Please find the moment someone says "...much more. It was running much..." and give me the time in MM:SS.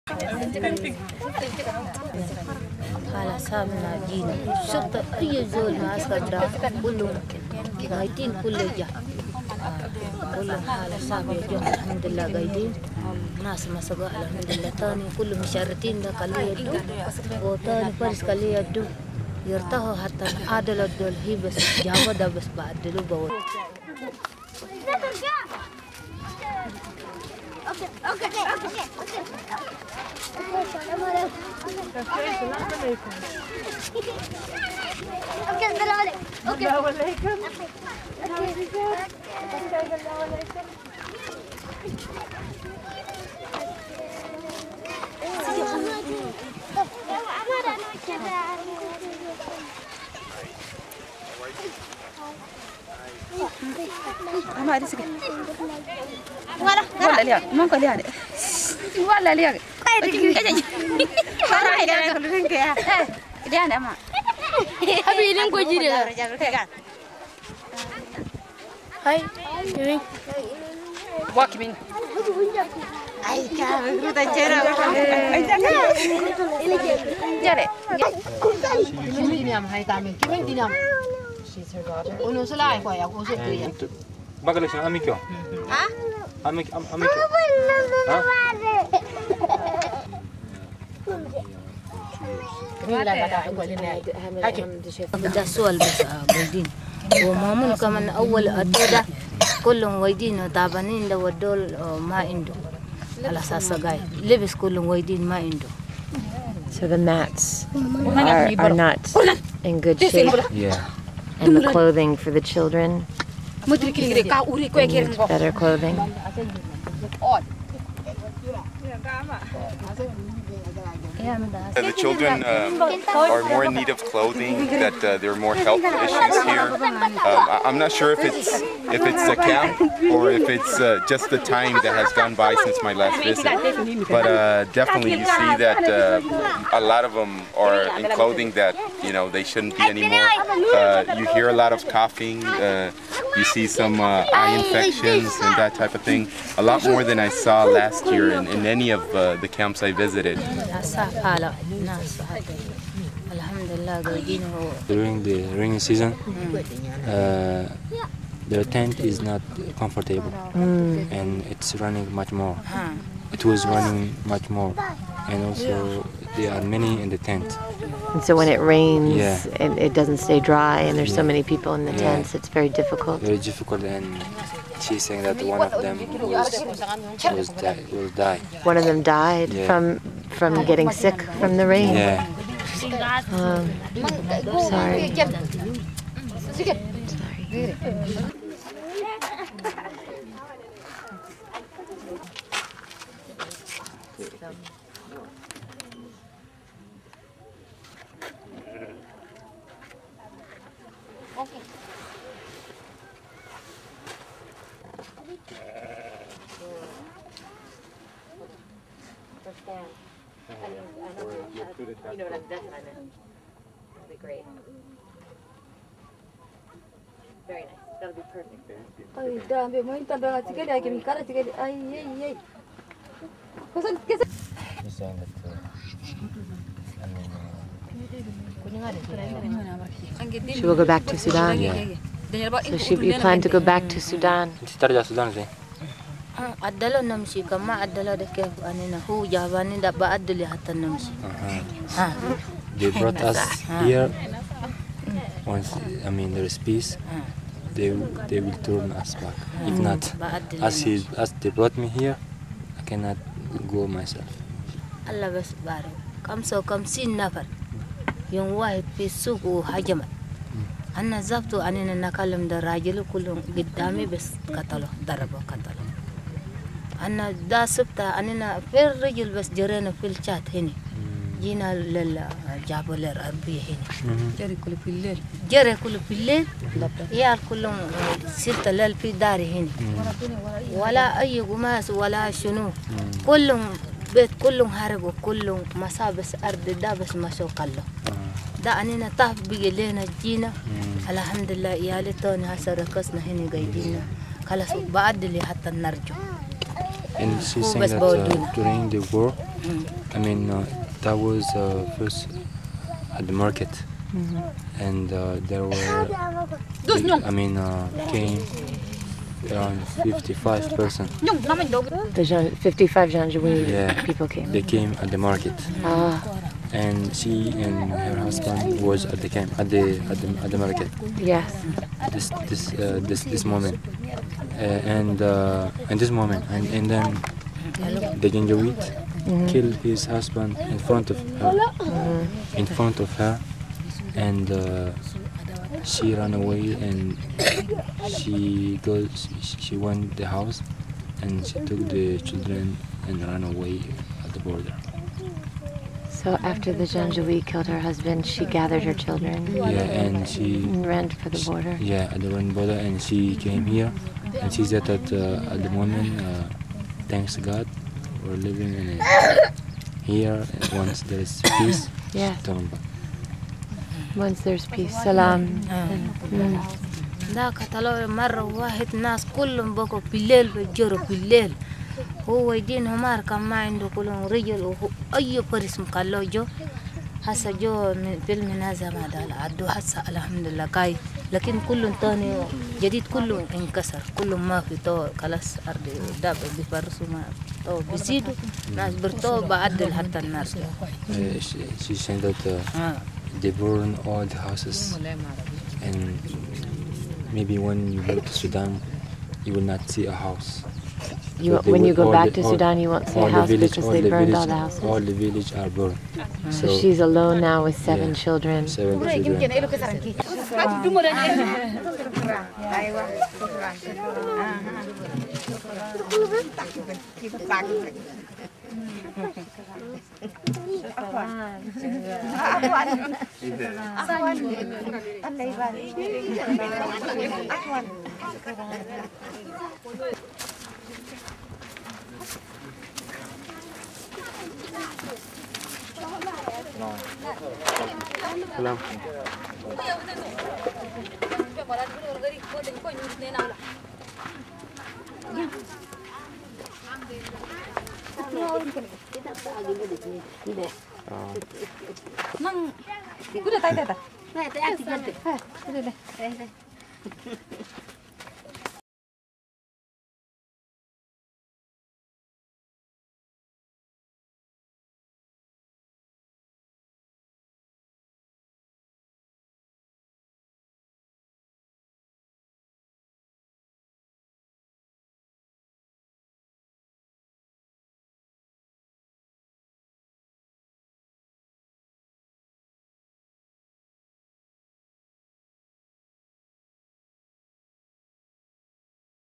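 02:42.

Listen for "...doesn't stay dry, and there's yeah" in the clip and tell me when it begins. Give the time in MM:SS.
02:49.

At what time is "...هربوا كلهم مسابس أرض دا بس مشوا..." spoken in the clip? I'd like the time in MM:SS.
04:44.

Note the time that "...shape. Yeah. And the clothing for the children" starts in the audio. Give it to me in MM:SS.
01:49.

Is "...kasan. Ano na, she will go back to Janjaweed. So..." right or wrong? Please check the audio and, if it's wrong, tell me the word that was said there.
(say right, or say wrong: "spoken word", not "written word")
wrong: "Sudan", not "Janjaweed".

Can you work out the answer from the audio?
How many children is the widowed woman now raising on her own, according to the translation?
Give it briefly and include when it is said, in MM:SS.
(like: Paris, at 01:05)
7, at 06:48.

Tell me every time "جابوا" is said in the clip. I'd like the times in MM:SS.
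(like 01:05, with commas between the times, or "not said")
00:21, 04:32.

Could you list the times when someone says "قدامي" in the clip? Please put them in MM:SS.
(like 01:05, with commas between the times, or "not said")
04:23.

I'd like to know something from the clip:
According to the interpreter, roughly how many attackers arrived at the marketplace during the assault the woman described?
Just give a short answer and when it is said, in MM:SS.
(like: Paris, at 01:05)
55, at 05:08.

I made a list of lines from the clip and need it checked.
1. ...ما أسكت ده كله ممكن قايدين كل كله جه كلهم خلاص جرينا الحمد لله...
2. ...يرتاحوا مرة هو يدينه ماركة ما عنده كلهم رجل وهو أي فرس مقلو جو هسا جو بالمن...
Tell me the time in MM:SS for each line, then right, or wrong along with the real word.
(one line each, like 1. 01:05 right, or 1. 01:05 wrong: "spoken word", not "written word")
1. 00:05 wrong: "هامنا", not "جرينا"
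2. 06:07 wrong: "طلعوا", not "يرتاحوا".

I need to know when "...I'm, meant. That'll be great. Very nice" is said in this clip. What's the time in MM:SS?
03:32.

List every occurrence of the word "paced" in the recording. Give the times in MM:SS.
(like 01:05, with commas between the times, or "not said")
not said.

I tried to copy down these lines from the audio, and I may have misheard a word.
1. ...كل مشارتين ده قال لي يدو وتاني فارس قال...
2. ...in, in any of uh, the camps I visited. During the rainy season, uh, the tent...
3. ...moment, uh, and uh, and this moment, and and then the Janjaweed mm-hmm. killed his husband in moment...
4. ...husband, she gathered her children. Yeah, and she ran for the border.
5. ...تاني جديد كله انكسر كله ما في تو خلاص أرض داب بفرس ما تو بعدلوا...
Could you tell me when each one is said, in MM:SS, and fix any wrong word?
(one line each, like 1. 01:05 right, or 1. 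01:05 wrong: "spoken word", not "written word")
1. 00:15 right
2. 02:28 right
3. 05:23 wrong: "front", not "moment"
4. 05:47 right
5. 06:22 wrong: "بيزيدوا", not "بعدلوا".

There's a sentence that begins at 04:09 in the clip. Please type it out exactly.
If not, as he as they brought me here, I cannot go myself.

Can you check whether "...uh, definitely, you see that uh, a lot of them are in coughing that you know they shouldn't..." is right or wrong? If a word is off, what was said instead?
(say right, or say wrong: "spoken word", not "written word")
wrong: "clothing", not "coughing".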